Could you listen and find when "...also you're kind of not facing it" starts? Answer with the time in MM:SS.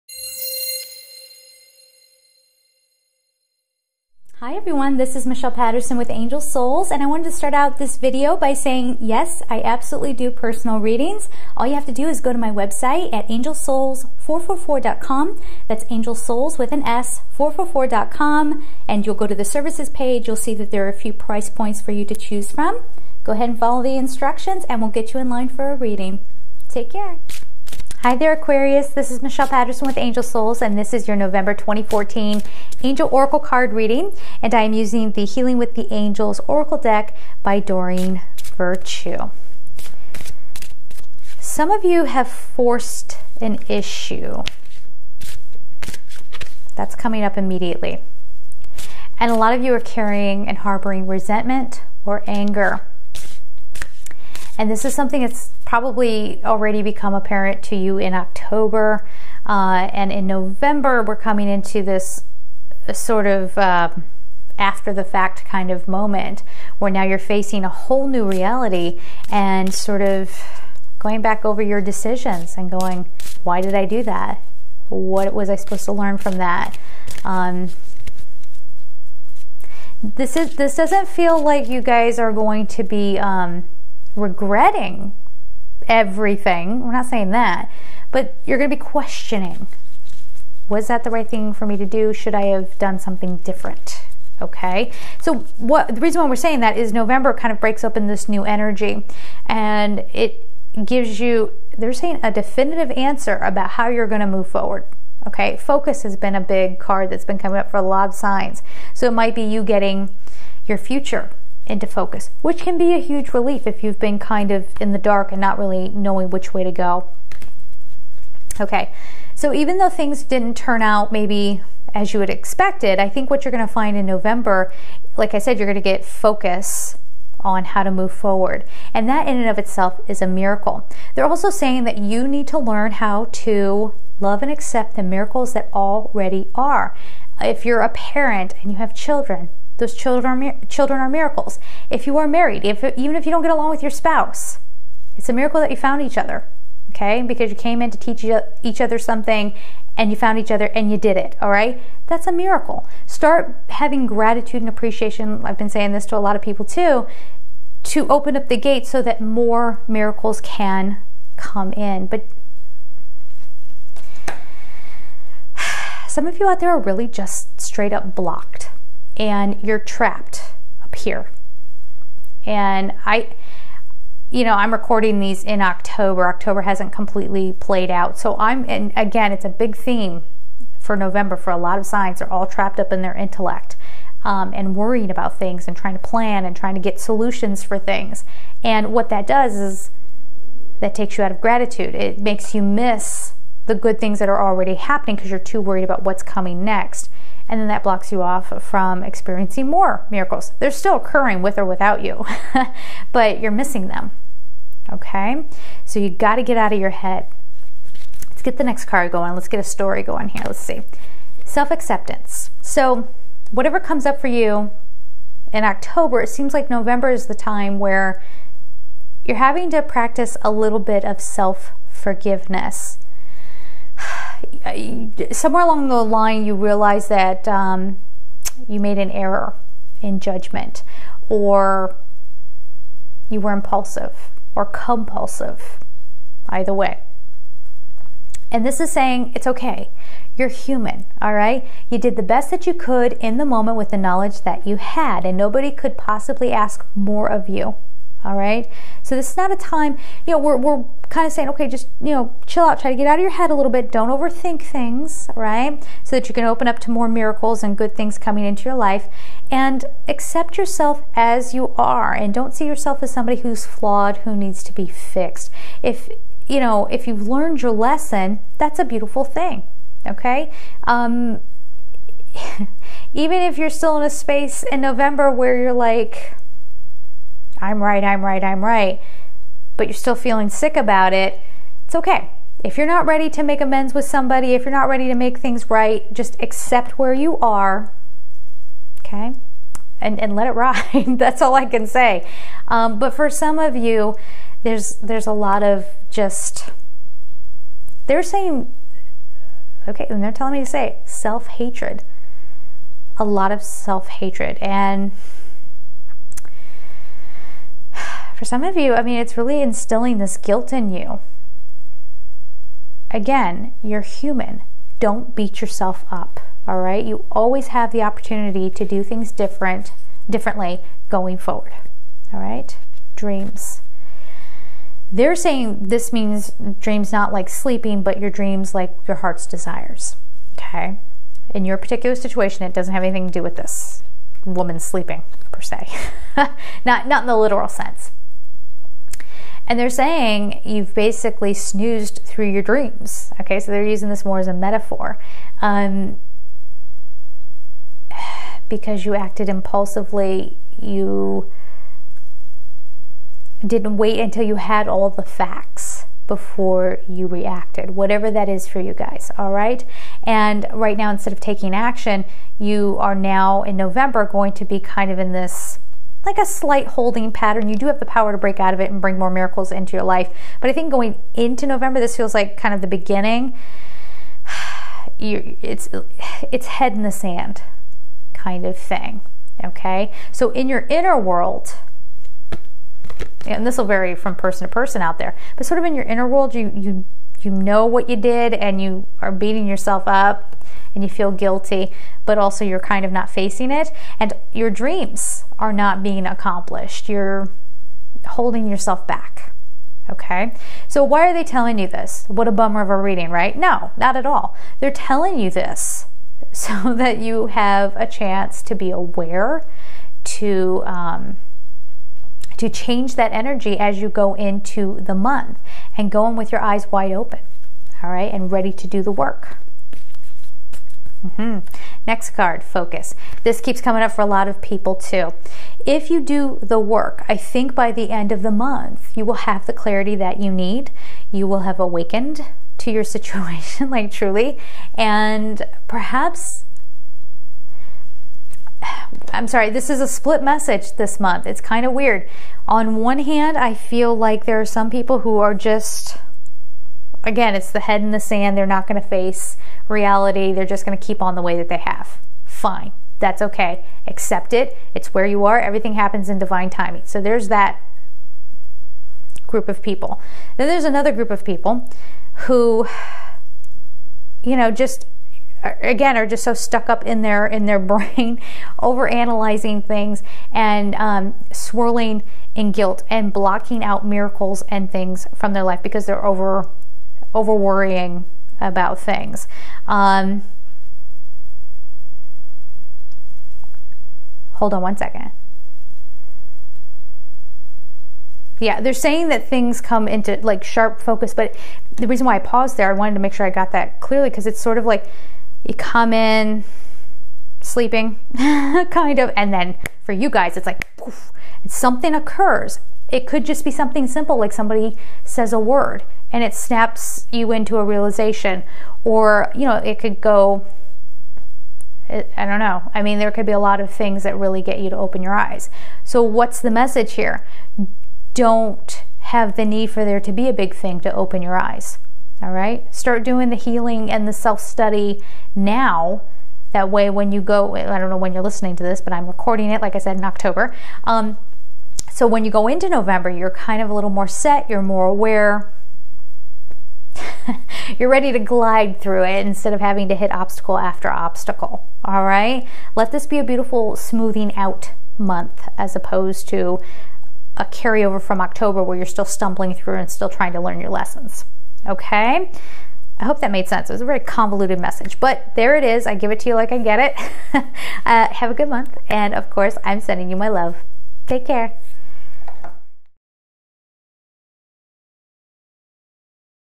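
06:32.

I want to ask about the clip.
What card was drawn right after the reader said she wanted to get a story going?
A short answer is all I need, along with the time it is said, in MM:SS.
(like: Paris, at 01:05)
Self acceptance, at 03:31.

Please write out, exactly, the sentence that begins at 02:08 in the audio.
And that in and of itself is a miracle.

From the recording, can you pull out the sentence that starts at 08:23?
It could just be something simple like somebody says a word and it snaps you into a realization.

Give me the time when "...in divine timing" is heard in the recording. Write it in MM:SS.
07:36.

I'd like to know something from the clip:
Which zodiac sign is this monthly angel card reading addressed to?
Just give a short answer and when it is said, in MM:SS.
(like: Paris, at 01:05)
Aquarius, at 00:28.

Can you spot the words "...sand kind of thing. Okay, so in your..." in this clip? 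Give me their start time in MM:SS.
06:17.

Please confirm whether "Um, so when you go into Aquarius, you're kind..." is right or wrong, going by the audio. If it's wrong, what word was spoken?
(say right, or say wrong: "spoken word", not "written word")
wrong: "November", not "Aquarius".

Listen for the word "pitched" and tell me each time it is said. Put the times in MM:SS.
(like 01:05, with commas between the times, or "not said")
not said.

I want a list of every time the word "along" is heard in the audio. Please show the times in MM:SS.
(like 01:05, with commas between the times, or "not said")
02:23, 03:45.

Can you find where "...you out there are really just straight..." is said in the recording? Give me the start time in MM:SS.
02:46.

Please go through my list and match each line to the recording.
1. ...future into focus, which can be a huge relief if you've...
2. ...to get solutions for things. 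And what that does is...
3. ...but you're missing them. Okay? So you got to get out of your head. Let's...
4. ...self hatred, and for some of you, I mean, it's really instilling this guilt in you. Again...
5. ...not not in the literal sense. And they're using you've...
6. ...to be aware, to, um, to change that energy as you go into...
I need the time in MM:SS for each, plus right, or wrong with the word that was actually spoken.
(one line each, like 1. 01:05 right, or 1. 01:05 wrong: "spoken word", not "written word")
1. 01:50 right
2. 03:06 right
3. 03:23 right
4. 05:03 right
5. 05:36 wrong: "saying", not "using"
6. 06:48 right.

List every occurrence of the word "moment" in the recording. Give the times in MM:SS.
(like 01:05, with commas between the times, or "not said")
01:05, 04:03.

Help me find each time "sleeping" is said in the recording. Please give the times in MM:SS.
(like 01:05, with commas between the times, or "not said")
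05:27, 05:34, 08:17.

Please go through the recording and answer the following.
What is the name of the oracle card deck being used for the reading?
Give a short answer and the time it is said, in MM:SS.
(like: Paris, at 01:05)
Healing with the Angels, at 00:35.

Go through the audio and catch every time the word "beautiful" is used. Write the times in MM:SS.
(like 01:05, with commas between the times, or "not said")
04:28, 09:03.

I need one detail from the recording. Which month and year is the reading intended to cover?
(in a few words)
November 2014.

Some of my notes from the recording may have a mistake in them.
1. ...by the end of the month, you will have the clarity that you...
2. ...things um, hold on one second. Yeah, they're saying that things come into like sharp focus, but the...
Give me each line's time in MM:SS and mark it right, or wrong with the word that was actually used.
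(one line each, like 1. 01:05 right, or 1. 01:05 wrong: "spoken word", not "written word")
1. 07:07 right
2. 07:58 right.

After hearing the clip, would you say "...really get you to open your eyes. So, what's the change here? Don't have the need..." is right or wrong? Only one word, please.
wrong.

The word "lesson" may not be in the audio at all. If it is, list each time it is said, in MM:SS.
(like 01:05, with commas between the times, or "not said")
04:27, 09:10.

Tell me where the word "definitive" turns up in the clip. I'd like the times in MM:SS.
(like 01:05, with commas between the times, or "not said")
01:42.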